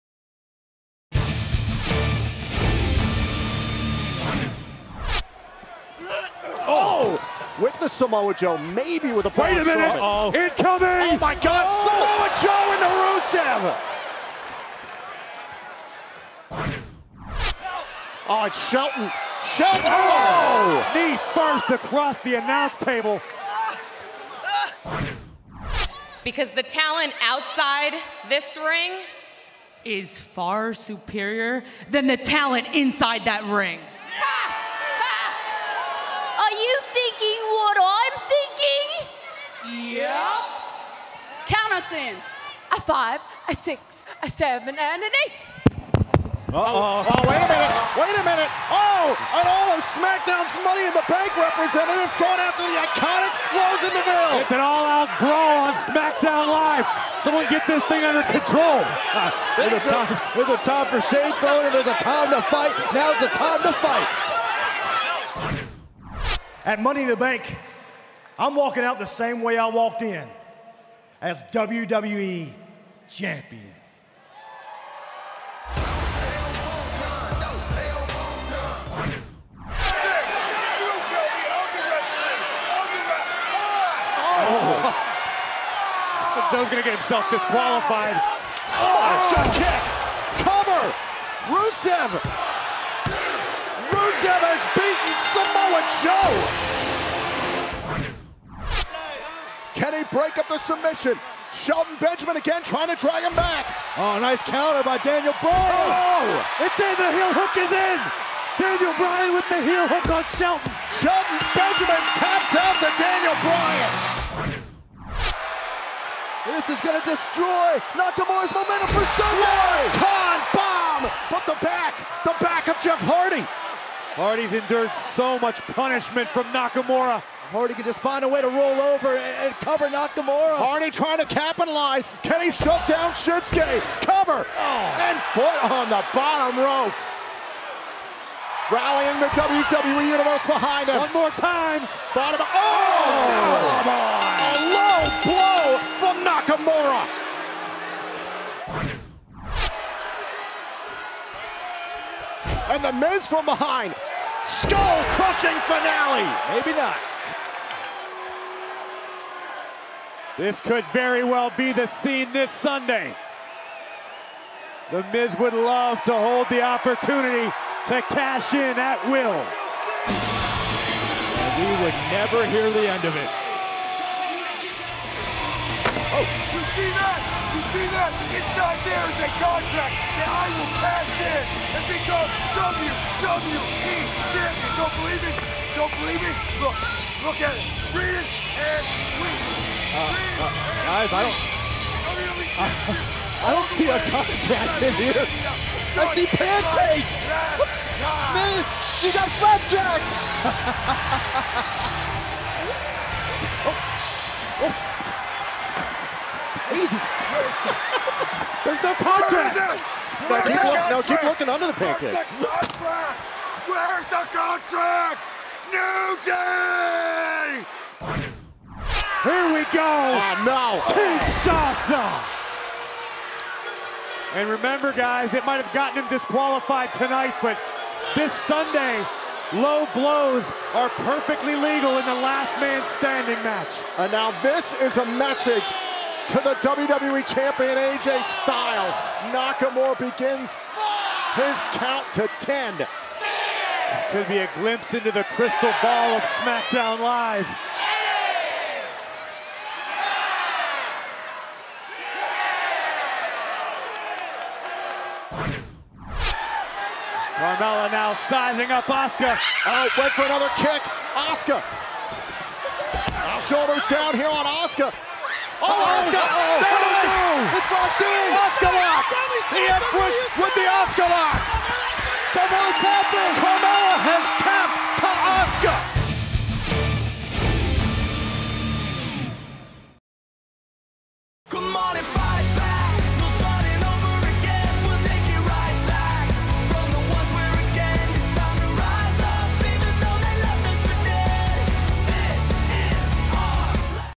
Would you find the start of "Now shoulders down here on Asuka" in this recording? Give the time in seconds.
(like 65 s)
263 s.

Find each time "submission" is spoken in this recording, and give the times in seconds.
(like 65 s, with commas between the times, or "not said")
100 s.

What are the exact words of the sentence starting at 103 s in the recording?
Oh, nice counter by Daniel Bryan.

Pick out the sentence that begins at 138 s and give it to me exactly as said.
Rallying the WWE Universe behind him.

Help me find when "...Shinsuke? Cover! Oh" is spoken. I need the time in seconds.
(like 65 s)
133 s.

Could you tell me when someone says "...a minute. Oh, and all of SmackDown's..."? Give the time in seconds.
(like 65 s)
48 s.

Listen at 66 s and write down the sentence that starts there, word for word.
At Money in the Bank, I'm walking out the same way I walked in as WWE champion.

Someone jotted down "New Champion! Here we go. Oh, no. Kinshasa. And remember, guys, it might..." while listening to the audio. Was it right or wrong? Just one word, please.
wrong.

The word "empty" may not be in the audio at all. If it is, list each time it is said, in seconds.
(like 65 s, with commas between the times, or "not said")
not said.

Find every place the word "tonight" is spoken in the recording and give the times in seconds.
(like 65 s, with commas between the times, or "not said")
226 s.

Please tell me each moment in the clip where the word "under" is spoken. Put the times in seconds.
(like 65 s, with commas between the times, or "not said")
58 s, 211 s.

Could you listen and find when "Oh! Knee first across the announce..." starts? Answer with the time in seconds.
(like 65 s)
19 s.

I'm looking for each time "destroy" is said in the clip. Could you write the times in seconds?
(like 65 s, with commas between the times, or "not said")
117 s.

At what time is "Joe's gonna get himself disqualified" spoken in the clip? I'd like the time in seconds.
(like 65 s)
86 s.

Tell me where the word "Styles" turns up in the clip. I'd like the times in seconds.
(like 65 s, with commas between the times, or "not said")
238 s.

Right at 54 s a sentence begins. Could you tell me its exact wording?
It's an all-out brawl on SmackDown Live.